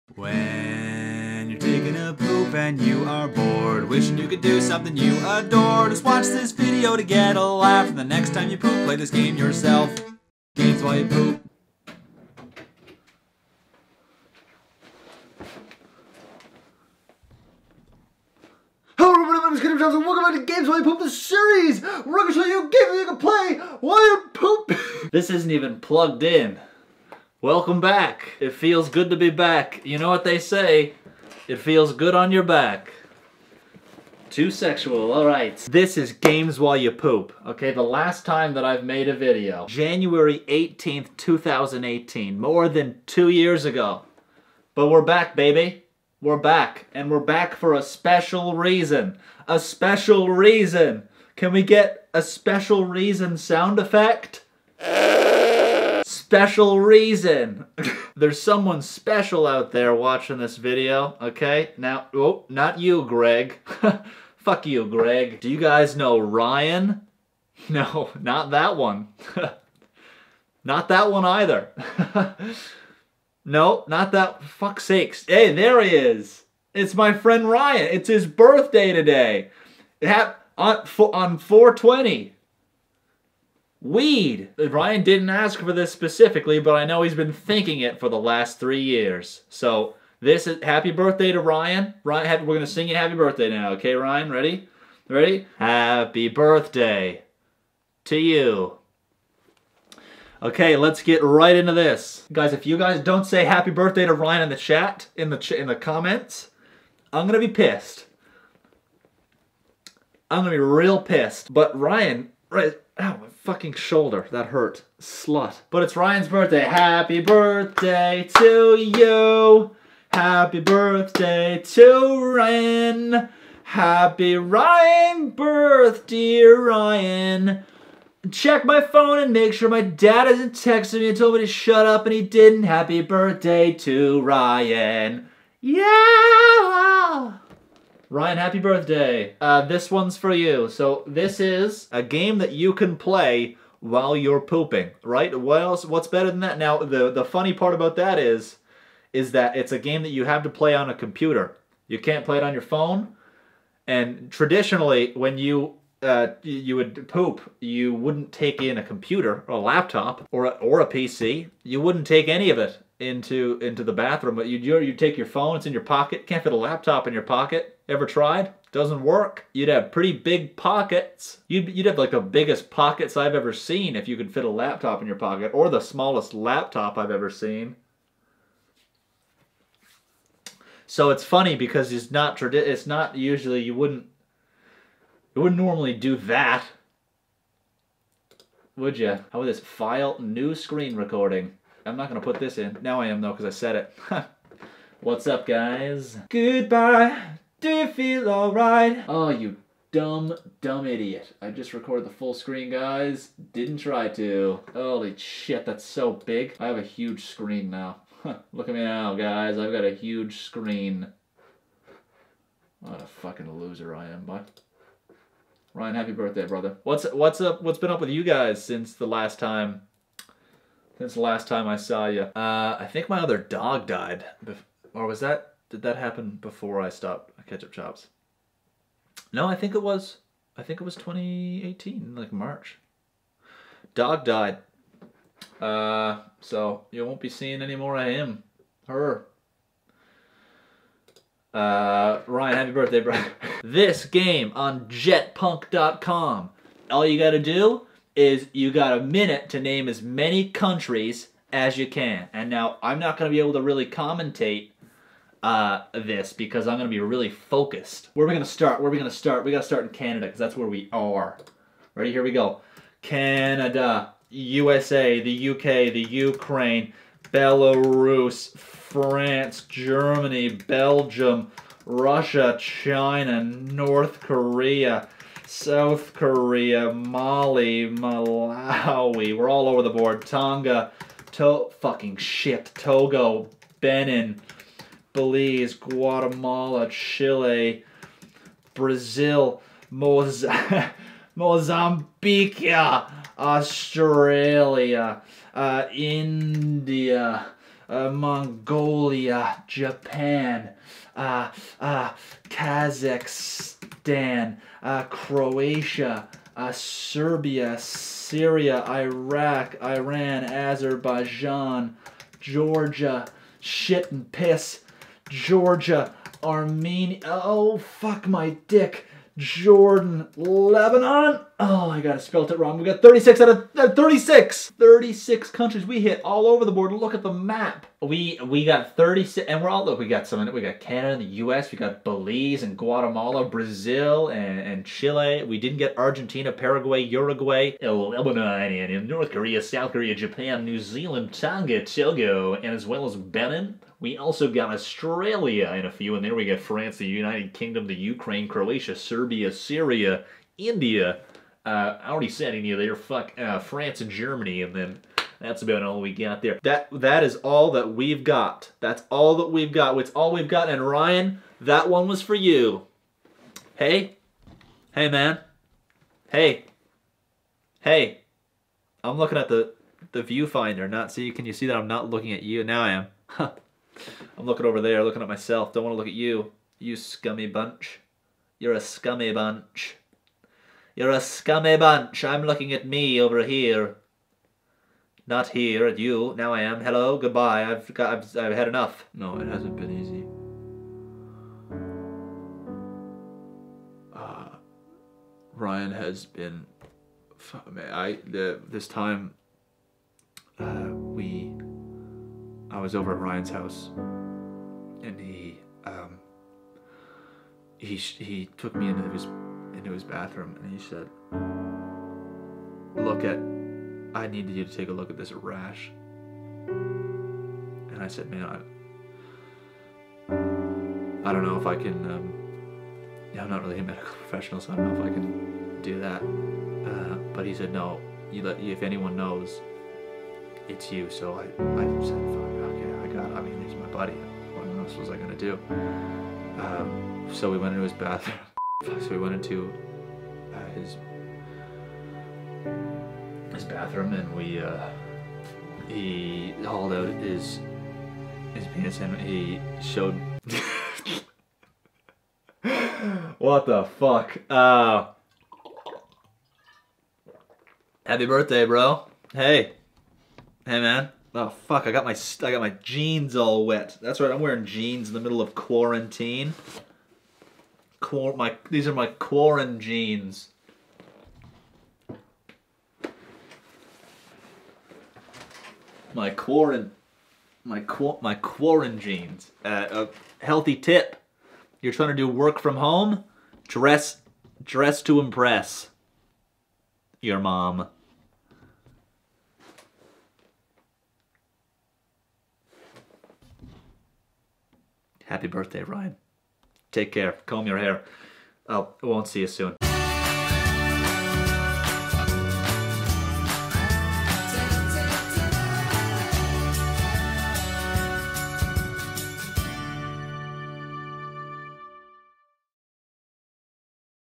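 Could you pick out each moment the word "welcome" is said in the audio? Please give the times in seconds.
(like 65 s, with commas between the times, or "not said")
19 s, 27 s.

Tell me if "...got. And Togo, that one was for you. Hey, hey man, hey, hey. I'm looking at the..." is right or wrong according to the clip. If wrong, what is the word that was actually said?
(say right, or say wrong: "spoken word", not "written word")
wrong: "Ryan", not "Togo".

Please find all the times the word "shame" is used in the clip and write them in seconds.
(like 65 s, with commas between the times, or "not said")
not said.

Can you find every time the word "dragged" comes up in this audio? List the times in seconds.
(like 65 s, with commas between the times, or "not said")
not said.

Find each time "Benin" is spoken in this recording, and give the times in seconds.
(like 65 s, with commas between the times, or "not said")
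283 s, 343 s.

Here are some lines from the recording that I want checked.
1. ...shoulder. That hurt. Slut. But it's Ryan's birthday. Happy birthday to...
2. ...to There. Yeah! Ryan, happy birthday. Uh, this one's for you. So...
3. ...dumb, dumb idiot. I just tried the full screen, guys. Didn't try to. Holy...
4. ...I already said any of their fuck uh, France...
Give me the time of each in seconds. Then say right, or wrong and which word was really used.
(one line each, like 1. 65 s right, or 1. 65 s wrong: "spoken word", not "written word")
1. 113 s right
2. 133 s wrong: "Ryan", not "There"
3. 199 s wrong: "recorded", not "tried"
4. 352 s right.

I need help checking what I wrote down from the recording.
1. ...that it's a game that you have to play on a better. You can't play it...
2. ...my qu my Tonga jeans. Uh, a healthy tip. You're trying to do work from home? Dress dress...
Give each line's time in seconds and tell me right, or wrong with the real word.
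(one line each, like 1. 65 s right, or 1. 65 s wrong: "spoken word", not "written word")
1. 149 s wrong: "computer", not "better"
2. 477 s wrong: "Quarren", not "Tonga".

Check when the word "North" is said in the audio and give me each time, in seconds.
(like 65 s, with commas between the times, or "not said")
273 s, 339 s.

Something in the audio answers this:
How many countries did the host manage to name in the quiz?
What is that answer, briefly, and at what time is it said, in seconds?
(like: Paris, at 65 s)
36, at 324 s.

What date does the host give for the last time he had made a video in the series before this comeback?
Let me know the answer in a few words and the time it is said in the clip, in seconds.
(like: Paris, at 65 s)
January 18th, 2018, at 39 s.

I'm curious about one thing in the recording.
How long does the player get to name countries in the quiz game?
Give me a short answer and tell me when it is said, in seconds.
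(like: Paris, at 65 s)
a minute, at 248 s.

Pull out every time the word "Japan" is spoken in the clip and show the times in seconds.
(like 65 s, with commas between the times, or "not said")
299 s, 340 s.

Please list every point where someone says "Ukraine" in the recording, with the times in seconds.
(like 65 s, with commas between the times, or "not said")
266 s, 347 s.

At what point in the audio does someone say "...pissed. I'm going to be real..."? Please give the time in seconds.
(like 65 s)
107 s.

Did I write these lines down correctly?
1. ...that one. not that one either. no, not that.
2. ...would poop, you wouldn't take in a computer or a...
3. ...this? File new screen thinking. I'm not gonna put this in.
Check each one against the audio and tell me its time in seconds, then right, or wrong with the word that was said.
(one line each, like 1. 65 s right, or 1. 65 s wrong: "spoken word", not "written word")
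1. 68 s right
2. 156 s right
3. 189 s wrong: "recording", not "thinking".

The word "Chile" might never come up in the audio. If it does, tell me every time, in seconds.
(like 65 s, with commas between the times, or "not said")
286 s, 334 s.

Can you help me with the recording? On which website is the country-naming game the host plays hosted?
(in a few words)
jetpunk.com.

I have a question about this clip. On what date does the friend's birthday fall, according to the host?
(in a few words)
420.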